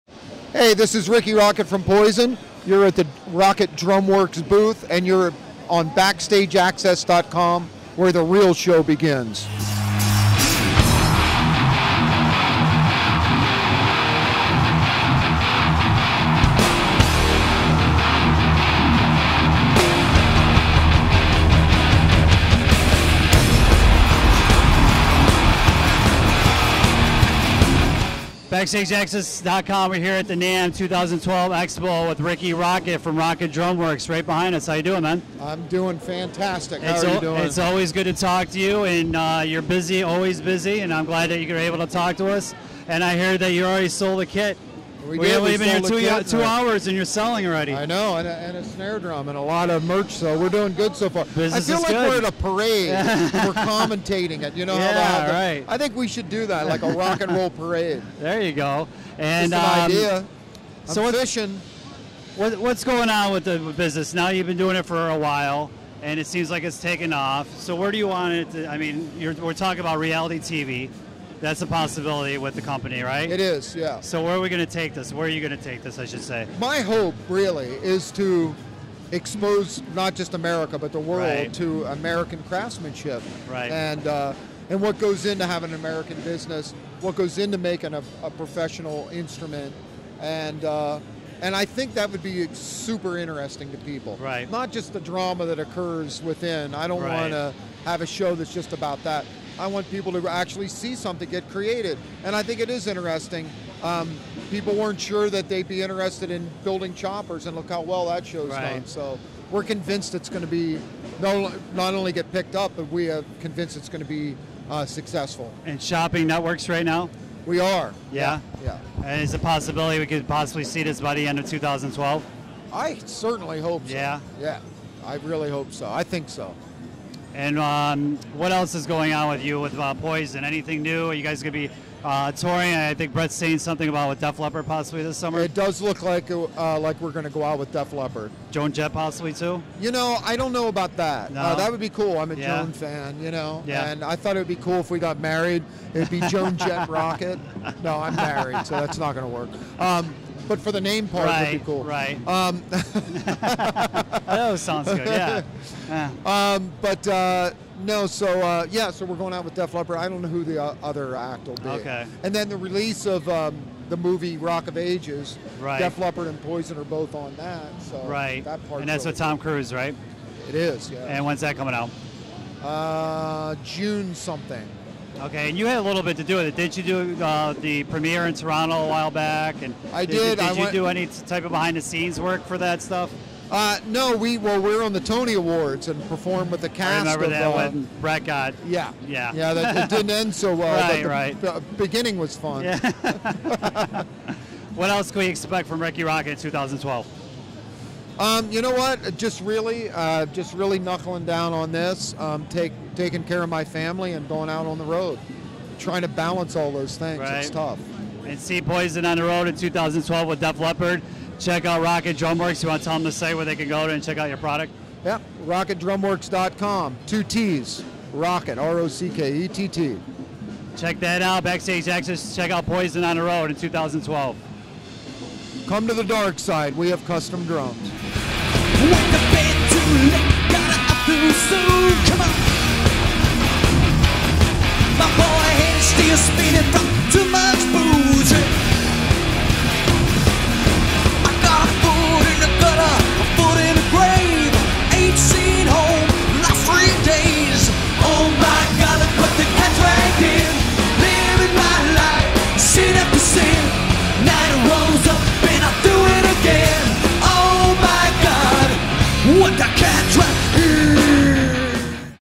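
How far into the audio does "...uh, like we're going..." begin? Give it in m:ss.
2:16.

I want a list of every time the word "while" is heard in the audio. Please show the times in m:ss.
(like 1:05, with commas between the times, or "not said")
1:05, 2:58.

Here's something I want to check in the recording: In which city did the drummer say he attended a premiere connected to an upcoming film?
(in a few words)
Toronto.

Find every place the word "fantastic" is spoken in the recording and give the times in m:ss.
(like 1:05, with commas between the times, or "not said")
0:35.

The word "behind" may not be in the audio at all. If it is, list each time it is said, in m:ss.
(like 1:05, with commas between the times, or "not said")
0:34, 3:01.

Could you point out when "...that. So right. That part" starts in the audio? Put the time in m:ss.
2:47.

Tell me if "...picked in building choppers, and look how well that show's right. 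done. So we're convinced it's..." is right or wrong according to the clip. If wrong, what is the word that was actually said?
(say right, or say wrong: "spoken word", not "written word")
wrong: "interested", not "picked".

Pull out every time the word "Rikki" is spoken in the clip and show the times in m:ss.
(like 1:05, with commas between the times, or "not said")
0:01, 0:32, 3:15.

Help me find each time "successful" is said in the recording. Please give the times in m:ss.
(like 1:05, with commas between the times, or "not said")
1:54.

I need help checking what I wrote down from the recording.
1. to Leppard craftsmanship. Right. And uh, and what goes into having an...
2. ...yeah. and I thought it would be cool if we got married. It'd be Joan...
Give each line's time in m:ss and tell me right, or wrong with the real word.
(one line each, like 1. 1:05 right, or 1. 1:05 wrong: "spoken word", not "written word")
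1. 1:21 wrong: "American", not "Leppard"
2. 2:23 right.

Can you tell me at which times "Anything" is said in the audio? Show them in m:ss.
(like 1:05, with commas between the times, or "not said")
2:10.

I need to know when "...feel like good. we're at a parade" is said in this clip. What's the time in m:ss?
0:51.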